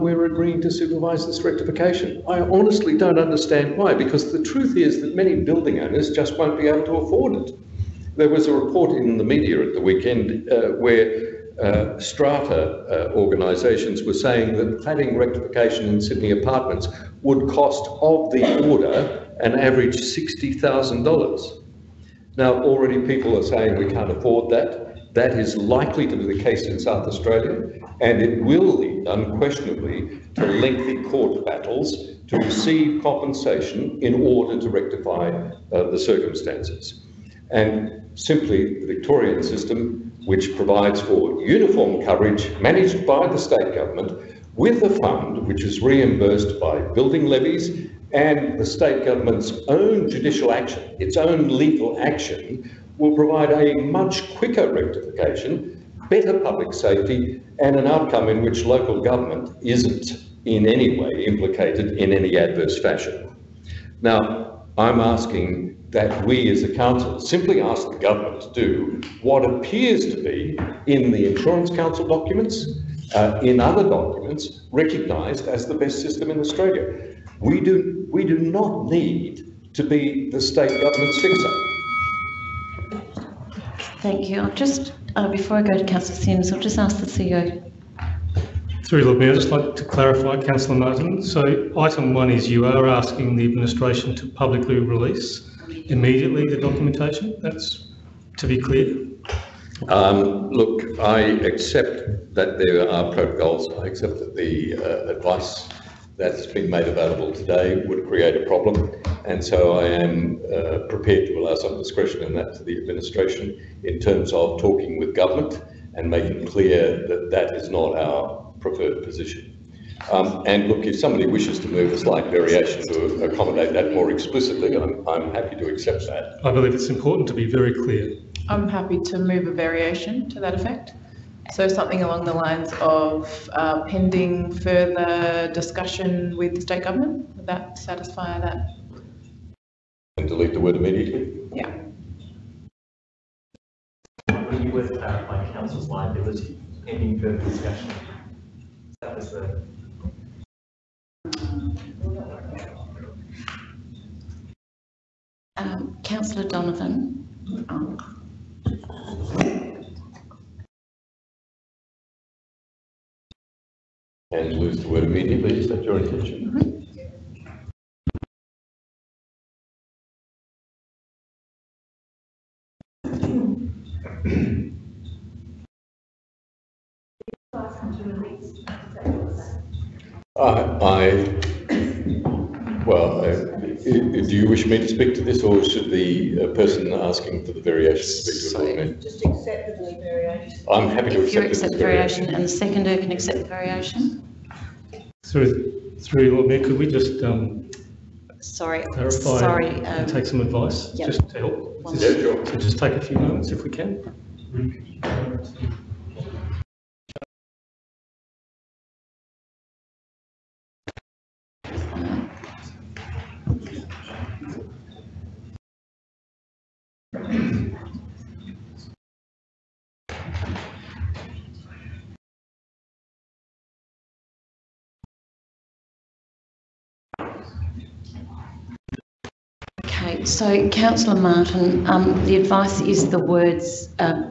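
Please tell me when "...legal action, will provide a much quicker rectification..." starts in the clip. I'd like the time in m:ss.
0:51.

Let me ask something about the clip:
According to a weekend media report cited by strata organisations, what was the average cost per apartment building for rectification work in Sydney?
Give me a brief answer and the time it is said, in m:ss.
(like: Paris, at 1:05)
$60,000, at 0:19.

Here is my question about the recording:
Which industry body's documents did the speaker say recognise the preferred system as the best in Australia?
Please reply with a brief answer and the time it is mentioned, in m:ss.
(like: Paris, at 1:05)
Insurance Council, at 1:11.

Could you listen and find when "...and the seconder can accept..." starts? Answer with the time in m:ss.
3:12.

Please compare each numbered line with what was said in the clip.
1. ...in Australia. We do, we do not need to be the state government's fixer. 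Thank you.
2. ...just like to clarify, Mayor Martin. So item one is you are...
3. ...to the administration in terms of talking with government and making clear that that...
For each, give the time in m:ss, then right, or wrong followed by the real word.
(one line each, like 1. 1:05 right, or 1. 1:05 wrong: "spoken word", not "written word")
1. 1:16 right
2. 1:29 wrong: "Councillor", not "Mayor"
3. 1:52 right.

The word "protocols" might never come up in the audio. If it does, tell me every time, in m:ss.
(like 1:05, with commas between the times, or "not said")
1:43.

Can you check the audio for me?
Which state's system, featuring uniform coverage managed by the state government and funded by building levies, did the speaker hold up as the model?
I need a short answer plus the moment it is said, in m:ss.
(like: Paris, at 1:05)
Victorian, at 0:38.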